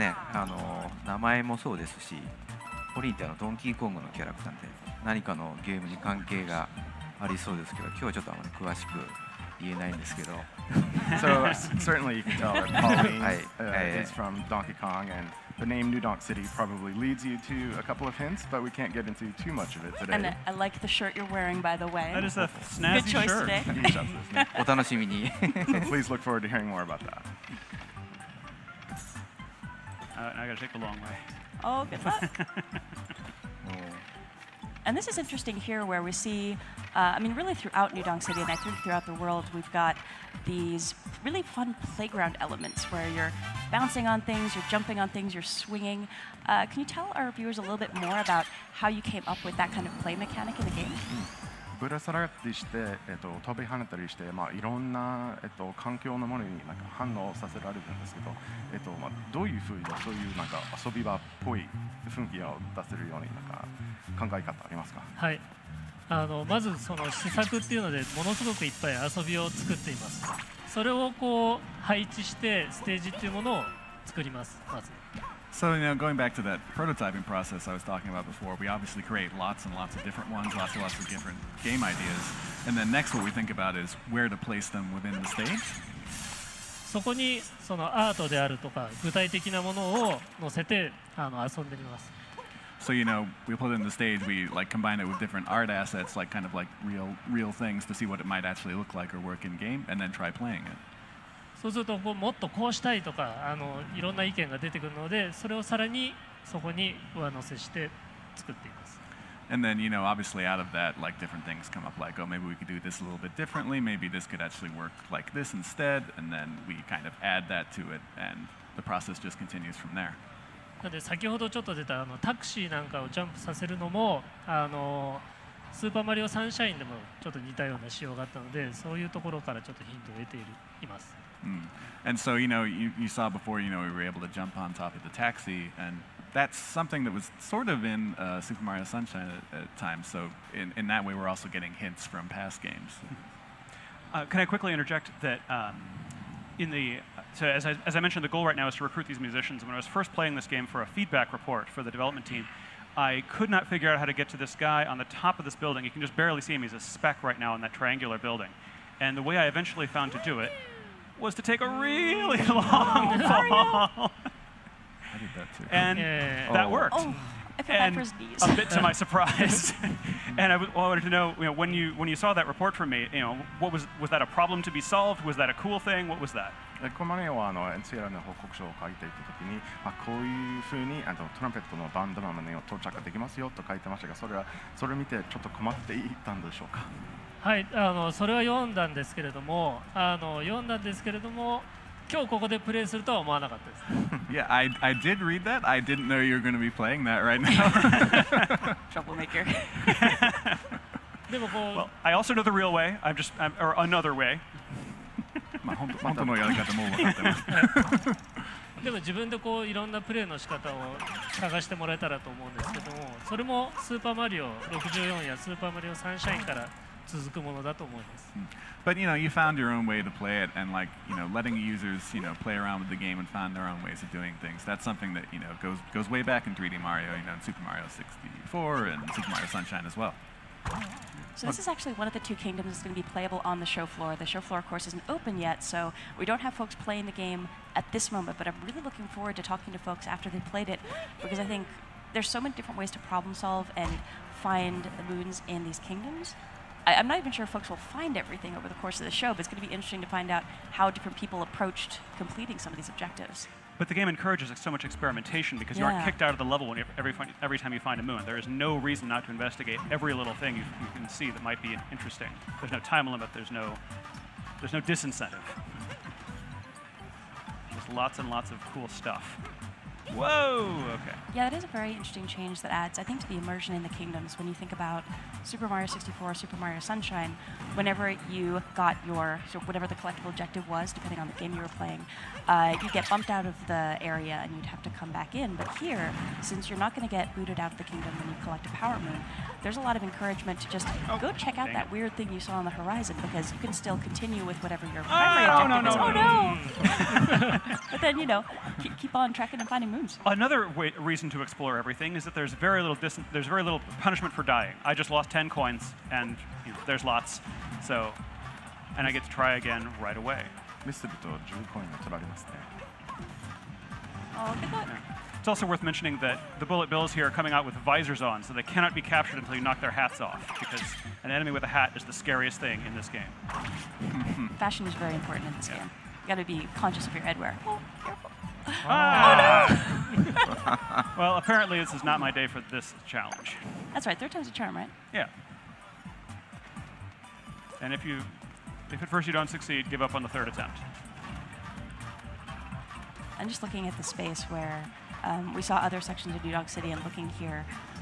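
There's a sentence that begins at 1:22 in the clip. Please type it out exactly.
And then next, what we think about is where to place them within the stage.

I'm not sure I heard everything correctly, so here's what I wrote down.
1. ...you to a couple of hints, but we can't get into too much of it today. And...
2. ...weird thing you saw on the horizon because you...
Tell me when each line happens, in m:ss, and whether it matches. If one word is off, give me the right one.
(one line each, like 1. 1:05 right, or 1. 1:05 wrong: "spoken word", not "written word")
1. 0:17 right
2. 4:51 right.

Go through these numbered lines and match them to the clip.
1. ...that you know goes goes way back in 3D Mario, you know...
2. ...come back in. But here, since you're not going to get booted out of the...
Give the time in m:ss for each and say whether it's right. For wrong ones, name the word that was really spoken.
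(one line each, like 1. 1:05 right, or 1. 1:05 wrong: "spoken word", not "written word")
1. 3:45 right
2. 4:44 right.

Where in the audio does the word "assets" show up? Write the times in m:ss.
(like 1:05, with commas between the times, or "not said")
1:35.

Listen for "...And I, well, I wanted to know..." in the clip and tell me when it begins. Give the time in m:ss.
2:50.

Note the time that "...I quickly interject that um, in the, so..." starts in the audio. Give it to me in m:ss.
2:24.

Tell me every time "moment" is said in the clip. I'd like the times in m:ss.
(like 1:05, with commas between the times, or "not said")
3:58.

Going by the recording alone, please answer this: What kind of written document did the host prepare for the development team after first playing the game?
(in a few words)
feedback report.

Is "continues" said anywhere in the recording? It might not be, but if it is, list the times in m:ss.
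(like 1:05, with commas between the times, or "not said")
1:59, 4:53.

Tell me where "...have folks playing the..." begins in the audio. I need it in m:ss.
3:56.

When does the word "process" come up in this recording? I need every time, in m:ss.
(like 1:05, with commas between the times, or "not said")
1:17, 1:58.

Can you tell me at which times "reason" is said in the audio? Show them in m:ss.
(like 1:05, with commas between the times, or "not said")
4:18, 5:00.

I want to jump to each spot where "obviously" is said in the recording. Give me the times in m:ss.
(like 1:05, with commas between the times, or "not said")
1:18, 1:50.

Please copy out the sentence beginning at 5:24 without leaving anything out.
Fashion is very important in this yeah.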